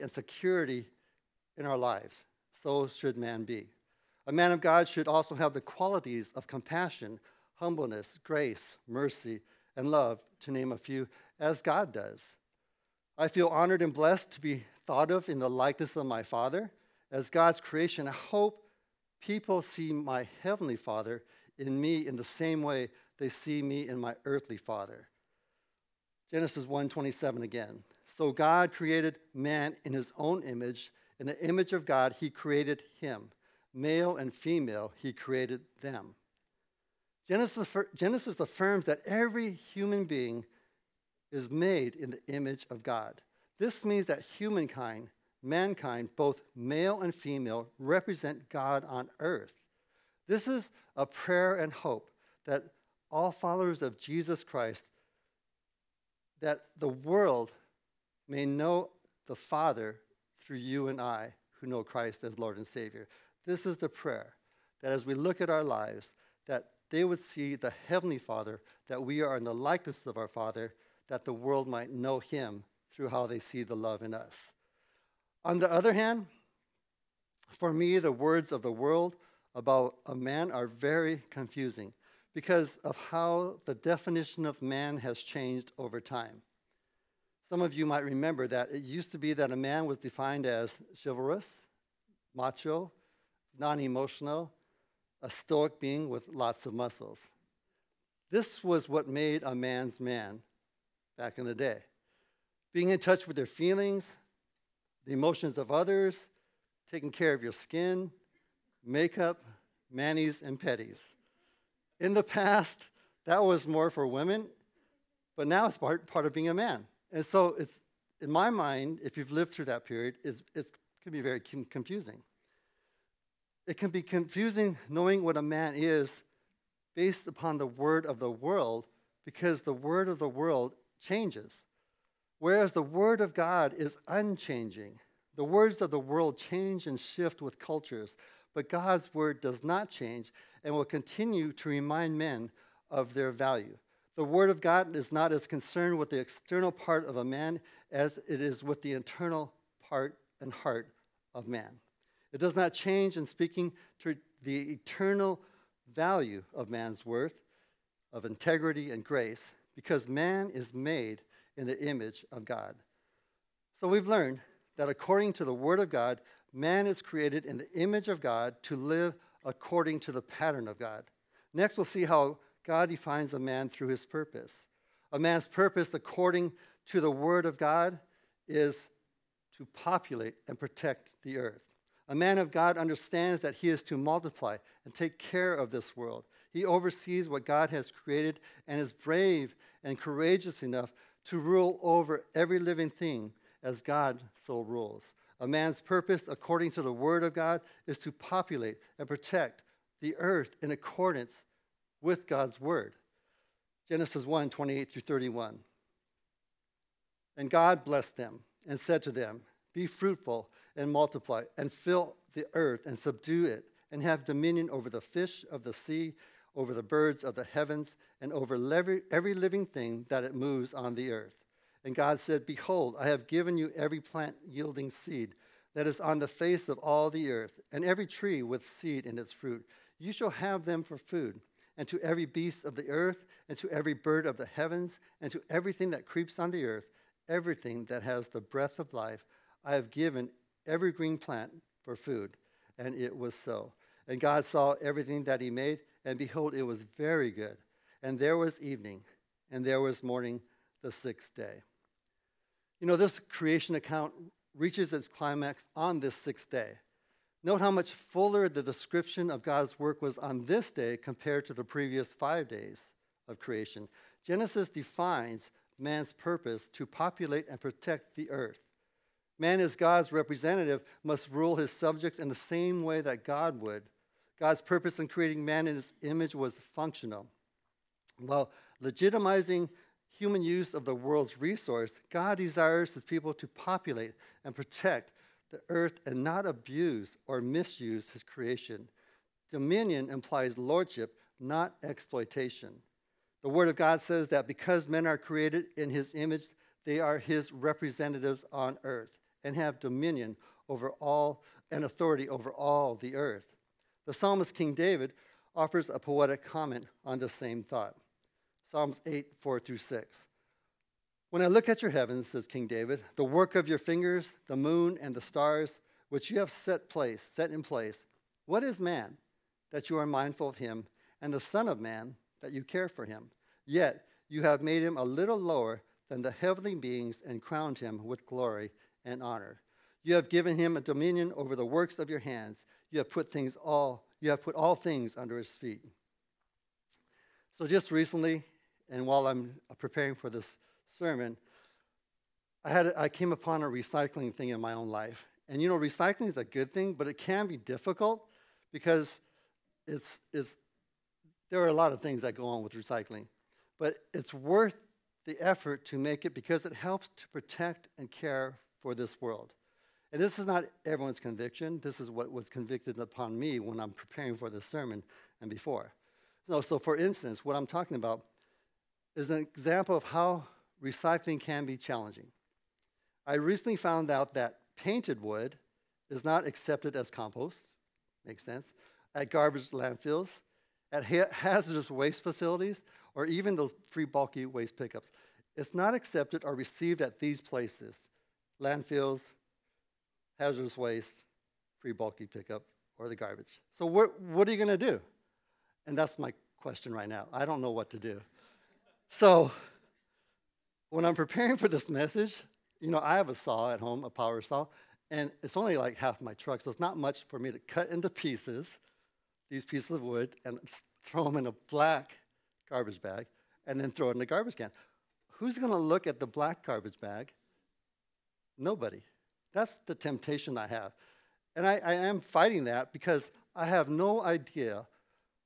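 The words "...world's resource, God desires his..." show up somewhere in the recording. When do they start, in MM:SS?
04:40.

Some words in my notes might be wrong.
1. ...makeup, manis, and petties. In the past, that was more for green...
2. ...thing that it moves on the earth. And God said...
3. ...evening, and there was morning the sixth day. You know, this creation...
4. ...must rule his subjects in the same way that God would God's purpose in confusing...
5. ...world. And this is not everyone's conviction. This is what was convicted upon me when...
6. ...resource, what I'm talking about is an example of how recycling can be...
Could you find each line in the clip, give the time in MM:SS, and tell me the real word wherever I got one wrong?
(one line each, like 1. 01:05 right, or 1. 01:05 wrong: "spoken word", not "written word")
1. 01:48 wrong: "women", not "green"
2. 03:39 right
3. 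04:08 right
4. 04:31 wrong: "creating", not "confusing"
5. 05:59 right
6. 06:06 wrong: "instance", not "resource".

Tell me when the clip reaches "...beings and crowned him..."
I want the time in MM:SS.
05:26.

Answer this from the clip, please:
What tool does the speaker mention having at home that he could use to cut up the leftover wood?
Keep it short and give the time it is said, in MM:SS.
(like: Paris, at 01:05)
power saw, at 06:44.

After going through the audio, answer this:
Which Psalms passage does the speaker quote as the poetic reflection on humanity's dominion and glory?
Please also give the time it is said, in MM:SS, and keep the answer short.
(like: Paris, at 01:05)
Psalms 8:4-6, at 05:08.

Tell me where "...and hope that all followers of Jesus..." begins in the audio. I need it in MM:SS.
00:51.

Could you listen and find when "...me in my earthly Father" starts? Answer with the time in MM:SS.
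00:23.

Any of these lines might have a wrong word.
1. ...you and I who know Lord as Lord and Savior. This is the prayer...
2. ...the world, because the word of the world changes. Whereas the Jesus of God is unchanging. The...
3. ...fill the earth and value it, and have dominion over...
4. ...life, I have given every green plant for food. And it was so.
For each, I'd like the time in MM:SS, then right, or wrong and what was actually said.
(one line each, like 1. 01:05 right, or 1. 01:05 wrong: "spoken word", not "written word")
1. 01:00 wrong: "Christ", not "Lord"
2. 02:08 wrong: "Word", not "Jesus"
3. 03:31 wrong: "subdue", not "value"
4. 03:58 right.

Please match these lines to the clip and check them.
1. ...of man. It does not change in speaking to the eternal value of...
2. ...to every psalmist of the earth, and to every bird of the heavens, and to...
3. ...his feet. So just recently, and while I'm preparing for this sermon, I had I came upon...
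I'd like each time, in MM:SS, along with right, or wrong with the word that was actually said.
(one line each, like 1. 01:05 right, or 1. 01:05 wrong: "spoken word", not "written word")
1. 02:31 right
2. 03:51 wrong: "beast", not "psalmist"
3. 05:35 right.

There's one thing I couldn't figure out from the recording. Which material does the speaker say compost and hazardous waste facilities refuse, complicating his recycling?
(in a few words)
painted wood.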